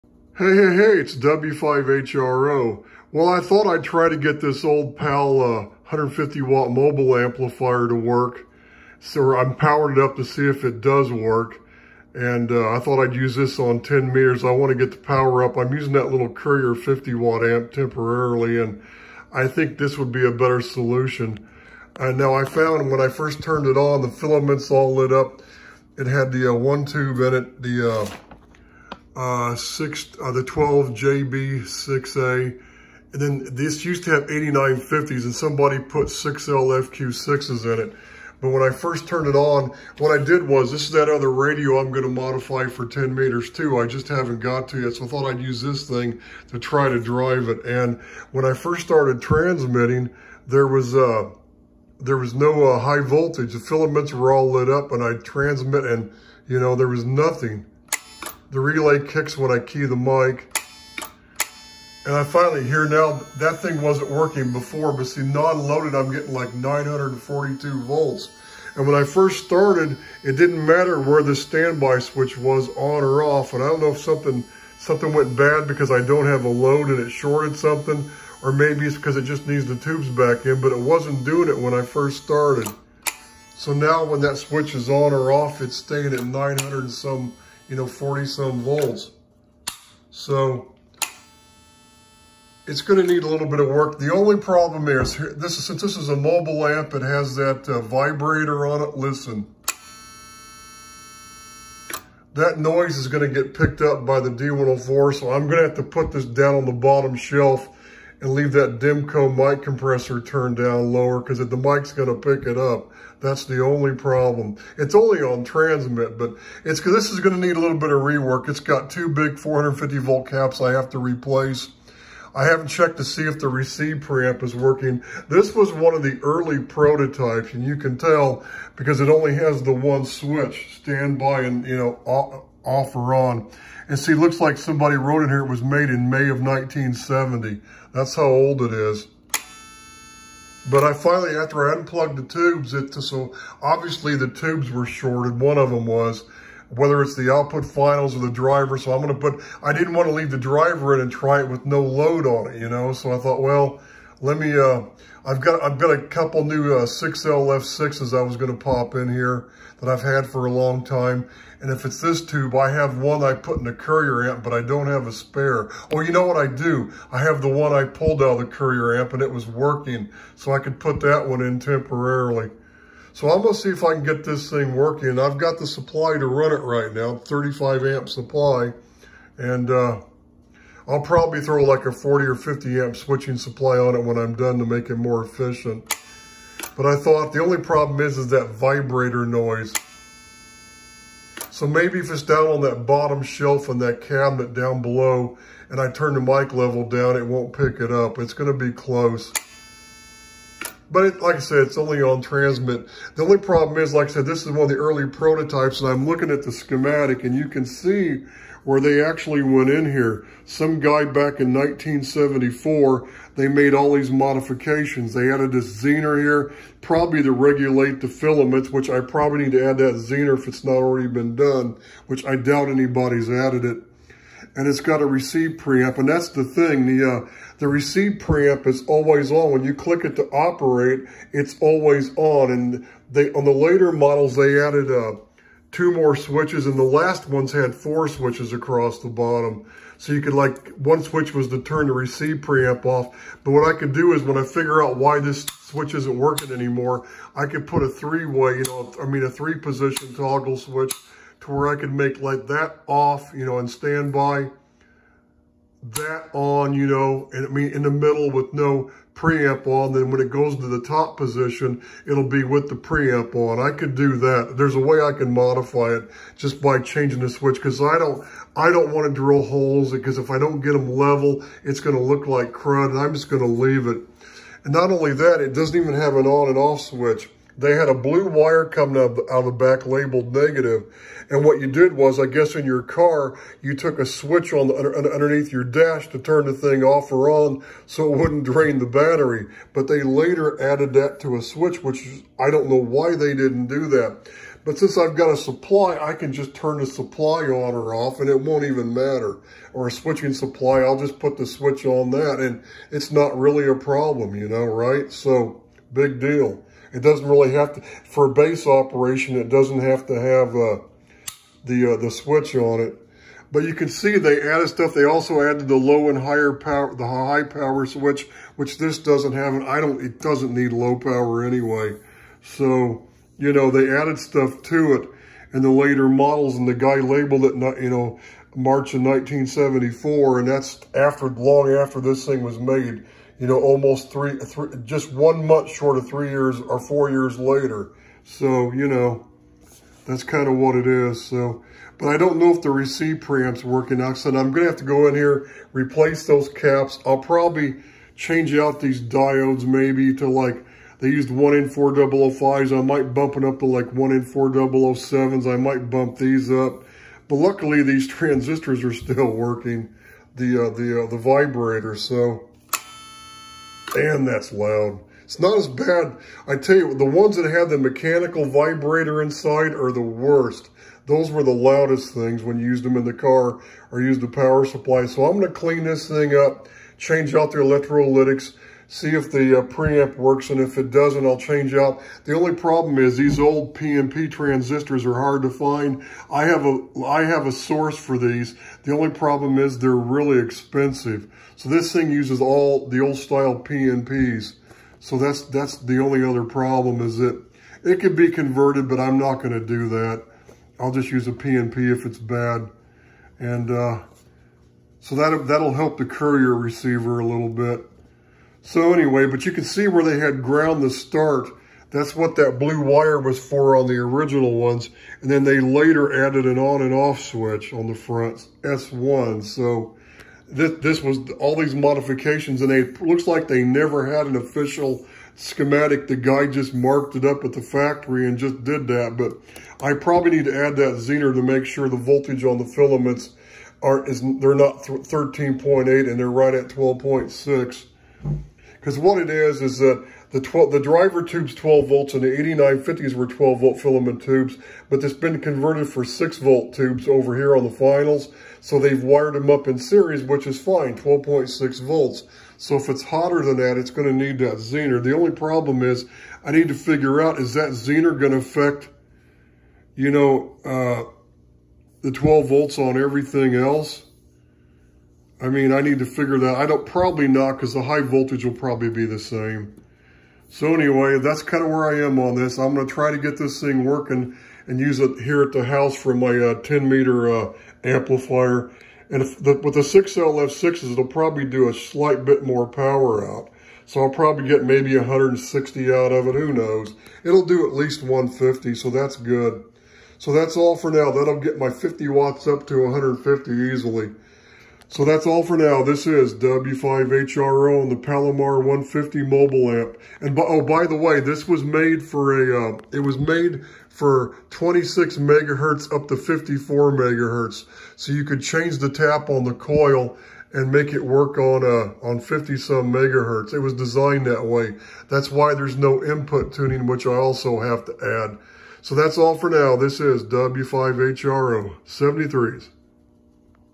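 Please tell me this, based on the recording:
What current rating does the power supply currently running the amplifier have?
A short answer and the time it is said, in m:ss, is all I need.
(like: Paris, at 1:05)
35 amp, at 2:57.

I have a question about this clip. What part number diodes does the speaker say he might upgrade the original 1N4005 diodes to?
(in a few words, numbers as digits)
1N4007.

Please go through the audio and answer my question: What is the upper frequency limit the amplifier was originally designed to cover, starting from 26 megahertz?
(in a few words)
54 megahertz.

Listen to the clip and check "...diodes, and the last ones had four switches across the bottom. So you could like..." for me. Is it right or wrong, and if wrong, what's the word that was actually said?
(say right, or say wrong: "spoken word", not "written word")
wrong: "switches", not "diodes".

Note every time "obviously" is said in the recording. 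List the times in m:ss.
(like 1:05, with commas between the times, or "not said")
2:23.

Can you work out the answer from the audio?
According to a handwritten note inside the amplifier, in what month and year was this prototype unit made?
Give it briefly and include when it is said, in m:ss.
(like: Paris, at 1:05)
May 1970, at 2:16.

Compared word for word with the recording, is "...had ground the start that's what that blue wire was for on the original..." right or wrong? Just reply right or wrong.
right.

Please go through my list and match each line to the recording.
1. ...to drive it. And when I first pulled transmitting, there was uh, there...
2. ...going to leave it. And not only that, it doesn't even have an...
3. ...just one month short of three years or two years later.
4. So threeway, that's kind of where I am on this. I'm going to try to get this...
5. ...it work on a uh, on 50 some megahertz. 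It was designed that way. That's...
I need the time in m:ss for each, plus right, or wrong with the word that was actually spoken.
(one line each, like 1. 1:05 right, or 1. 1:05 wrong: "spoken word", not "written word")
1. 0:46 wrong: "started", not "pulled"
2. 4:33 right
3. 5:34 wrong: "four", not "two"
4. 7:50 wrong: "anyway", not "threeway"
5. 8:30 right.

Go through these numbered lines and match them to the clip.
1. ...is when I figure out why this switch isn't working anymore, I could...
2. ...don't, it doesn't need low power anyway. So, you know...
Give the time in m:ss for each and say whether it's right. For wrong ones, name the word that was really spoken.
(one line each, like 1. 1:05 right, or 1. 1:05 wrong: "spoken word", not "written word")
1. 4:04 right
2. 5:19 right.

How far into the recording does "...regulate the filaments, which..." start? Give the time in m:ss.
3:37.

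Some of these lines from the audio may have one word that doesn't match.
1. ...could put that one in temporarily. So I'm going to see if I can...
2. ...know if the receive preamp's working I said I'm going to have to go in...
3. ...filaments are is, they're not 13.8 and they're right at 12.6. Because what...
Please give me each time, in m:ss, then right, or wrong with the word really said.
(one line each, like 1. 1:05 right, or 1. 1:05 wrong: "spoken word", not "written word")
1. 2:50 right
2. 5:42 right
3. 7:12 right.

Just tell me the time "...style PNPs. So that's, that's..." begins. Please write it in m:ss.
6:33.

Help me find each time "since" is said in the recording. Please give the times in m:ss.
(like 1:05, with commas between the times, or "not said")
1:35, 4:54.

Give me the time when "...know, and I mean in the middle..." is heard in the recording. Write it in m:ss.
4:16.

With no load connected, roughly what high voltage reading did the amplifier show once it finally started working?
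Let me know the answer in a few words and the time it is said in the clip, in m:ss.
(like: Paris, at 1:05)
942 volts, at 1:06.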